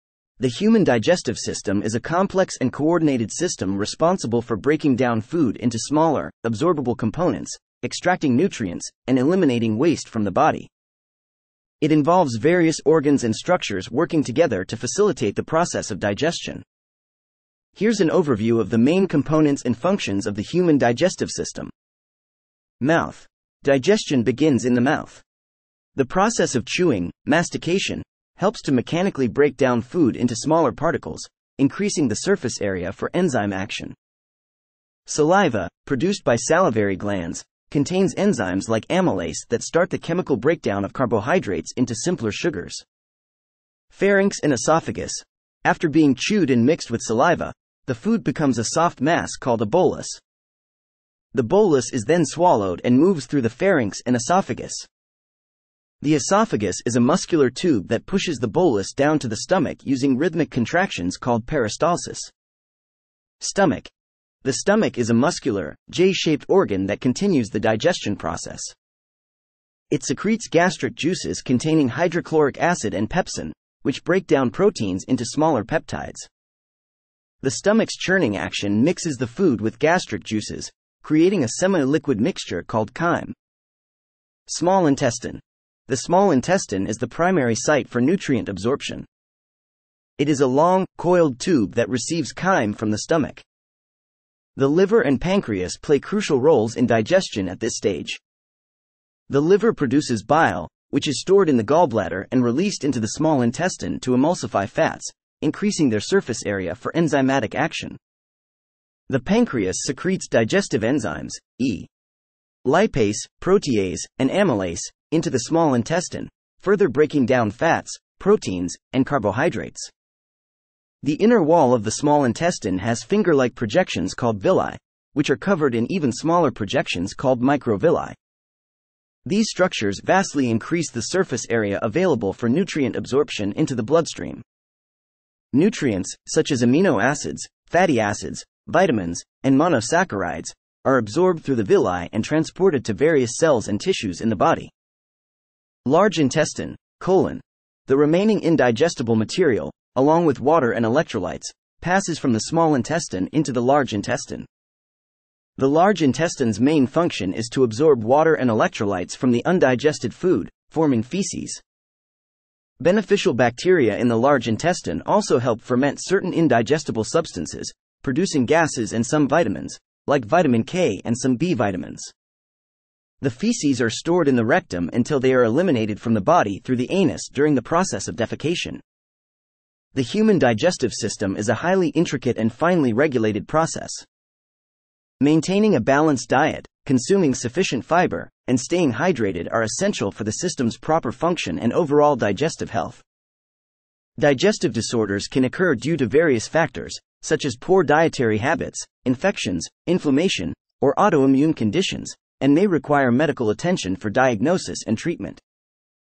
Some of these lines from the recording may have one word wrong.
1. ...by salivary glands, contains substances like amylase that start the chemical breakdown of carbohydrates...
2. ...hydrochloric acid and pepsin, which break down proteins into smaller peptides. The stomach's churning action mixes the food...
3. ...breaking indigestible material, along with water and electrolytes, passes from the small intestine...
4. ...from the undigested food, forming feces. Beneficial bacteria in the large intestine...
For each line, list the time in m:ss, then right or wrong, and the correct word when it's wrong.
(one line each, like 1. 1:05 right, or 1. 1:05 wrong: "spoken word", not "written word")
1. 0:36 wrong: "enzymes", not "substances"
2. 1:11 right
3. 2:27 wrong: "remaining", not "breaking"
4. 2:39 right.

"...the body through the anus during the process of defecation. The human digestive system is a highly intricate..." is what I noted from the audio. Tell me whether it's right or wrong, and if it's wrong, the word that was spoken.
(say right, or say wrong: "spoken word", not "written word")
right.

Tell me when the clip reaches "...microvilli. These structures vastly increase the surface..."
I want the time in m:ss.
2:07.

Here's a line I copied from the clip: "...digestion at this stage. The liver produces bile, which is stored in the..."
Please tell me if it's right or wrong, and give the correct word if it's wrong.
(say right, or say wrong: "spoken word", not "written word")
right.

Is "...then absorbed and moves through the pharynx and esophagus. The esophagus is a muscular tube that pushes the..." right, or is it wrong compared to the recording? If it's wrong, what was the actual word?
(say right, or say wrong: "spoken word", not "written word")
wrong: "swallowed", not "absorbed".